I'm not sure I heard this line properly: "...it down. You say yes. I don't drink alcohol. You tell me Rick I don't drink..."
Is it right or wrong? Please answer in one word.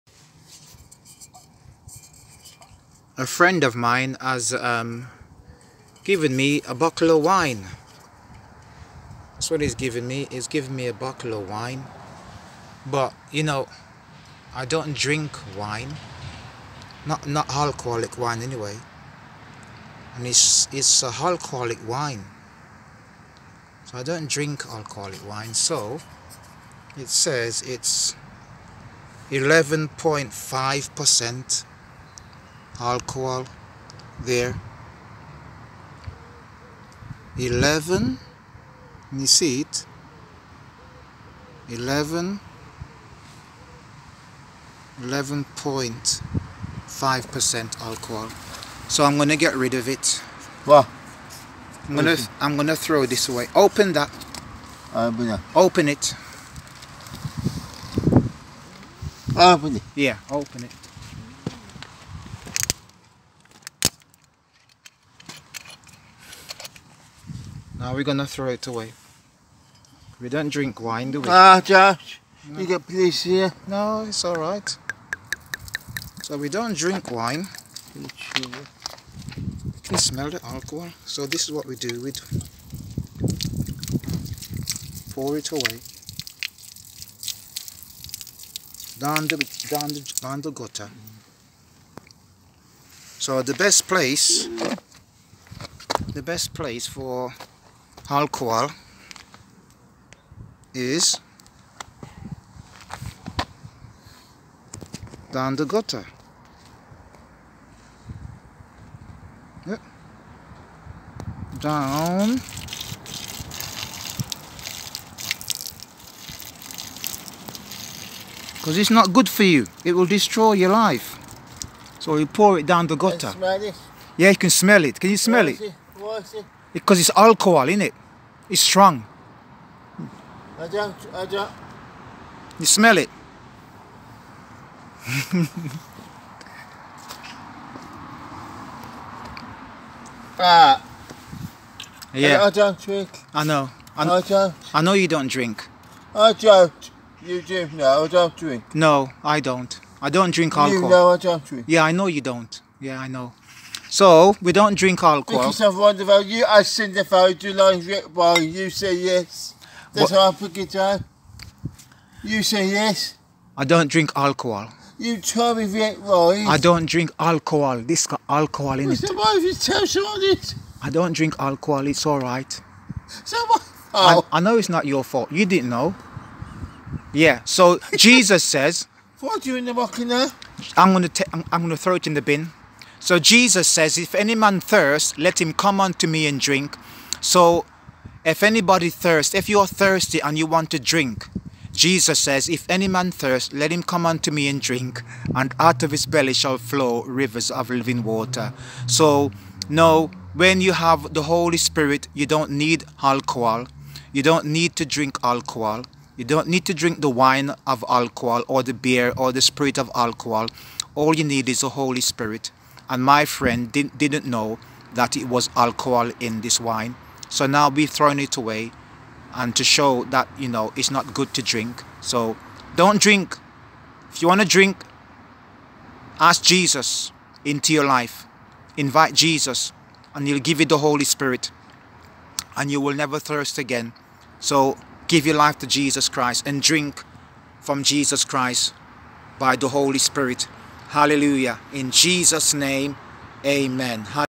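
right.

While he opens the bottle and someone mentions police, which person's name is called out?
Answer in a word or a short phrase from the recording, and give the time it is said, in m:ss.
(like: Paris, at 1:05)
Josh, at 1:11.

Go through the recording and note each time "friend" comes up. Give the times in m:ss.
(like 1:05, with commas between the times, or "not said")
0:03, 3:33.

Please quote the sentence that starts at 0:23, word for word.
So I don't drink alcoholic wine.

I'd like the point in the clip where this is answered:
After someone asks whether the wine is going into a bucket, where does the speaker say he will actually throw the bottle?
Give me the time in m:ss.
3:02.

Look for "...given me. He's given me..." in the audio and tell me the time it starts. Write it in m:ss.
0:09.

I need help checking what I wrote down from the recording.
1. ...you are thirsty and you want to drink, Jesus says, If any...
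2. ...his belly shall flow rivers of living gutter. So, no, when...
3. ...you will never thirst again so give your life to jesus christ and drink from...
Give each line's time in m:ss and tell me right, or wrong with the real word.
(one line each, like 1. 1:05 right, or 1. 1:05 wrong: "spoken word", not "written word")
1. 3:09 right
2. 3:15 wrong: "water", not "gutter"
3. 3:52 right.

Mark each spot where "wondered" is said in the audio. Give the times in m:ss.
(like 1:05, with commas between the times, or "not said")
2:35.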